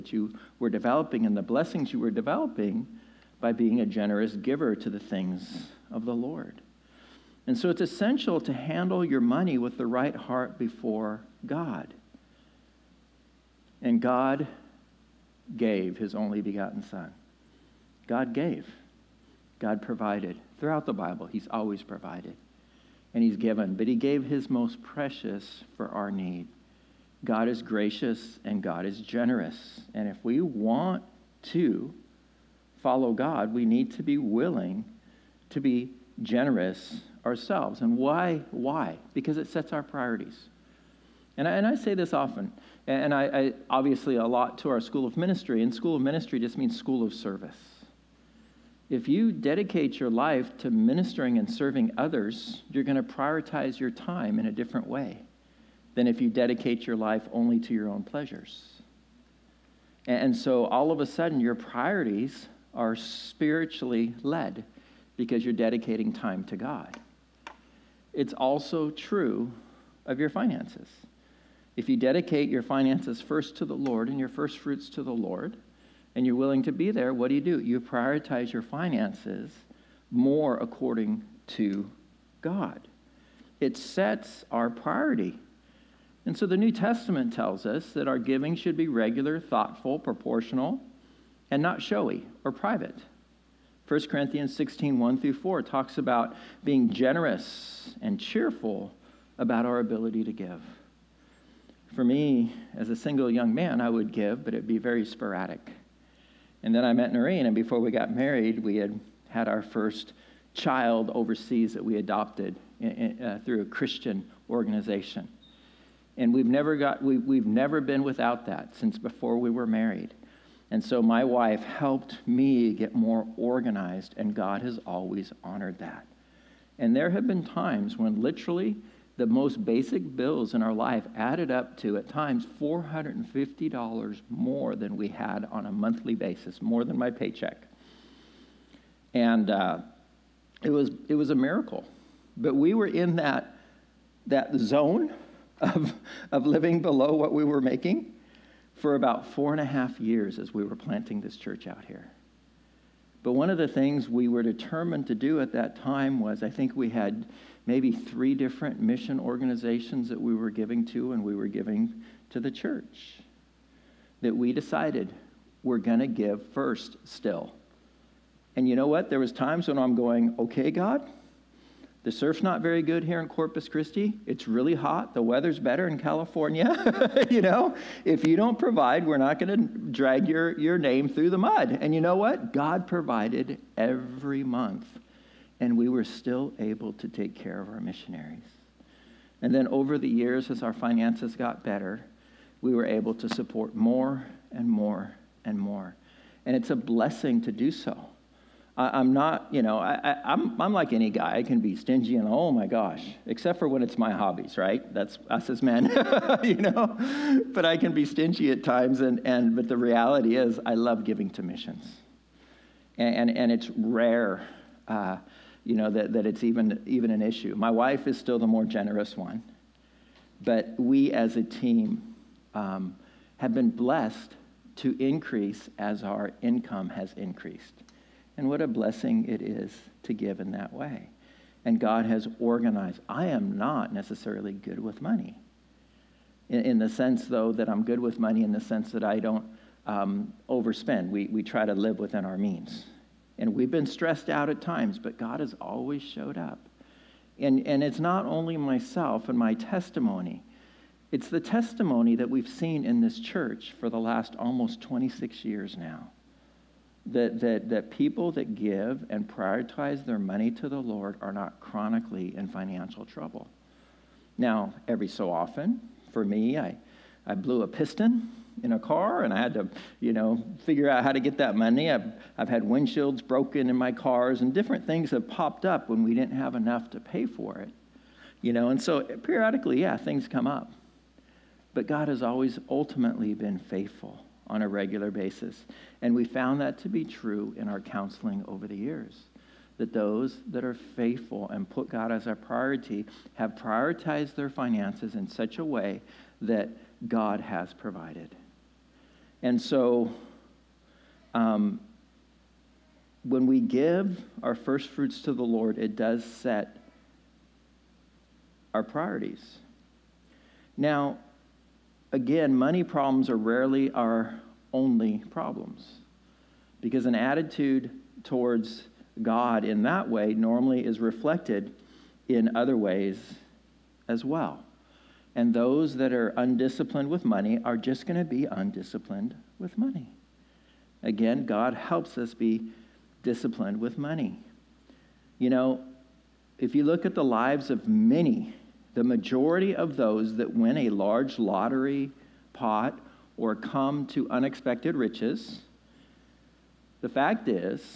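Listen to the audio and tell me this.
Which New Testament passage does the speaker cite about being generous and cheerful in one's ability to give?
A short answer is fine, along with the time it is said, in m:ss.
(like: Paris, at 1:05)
1 Corinthians 16:1-4, at 1:33.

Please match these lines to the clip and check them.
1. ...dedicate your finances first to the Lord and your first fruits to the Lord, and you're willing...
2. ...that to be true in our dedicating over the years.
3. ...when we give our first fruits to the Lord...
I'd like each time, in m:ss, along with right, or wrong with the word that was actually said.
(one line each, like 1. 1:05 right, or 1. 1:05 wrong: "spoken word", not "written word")
1. 1:11 right
2. 4:46 wrong: "counseling", not "dedicating"
3. 5:03 right.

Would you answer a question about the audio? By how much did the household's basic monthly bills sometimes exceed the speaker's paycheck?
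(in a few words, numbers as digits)
$450.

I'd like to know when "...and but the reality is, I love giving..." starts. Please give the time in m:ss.
3:29.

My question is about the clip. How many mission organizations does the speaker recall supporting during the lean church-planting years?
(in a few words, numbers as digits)
3.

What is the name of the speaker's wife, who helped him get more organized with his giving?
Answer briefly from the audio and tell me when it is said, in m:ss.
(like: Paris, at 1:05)
Noreen, at 1:47.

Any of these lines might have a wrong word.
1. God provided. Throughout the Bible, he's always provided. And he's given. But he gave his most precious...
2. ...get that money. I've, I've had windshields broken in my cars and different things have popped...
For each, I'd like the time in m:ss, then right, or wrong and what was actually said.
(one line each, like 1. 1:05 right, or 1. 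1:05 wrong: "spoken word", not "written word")
1. 0:19 right
2. 4:31 right.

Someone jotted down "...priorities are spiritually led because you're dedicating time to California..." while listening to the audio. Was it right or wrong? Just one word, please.
wrong.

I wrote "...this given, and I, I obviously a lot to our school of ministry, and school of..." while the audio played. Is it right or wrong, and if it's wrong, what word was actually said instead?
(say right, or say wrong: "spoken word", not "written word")
wrong: "often", not "given".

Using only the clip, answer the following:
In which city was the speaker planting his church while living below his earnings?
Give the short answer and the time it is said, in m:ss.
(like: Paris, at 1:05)
Corpus Christi, at 2:53.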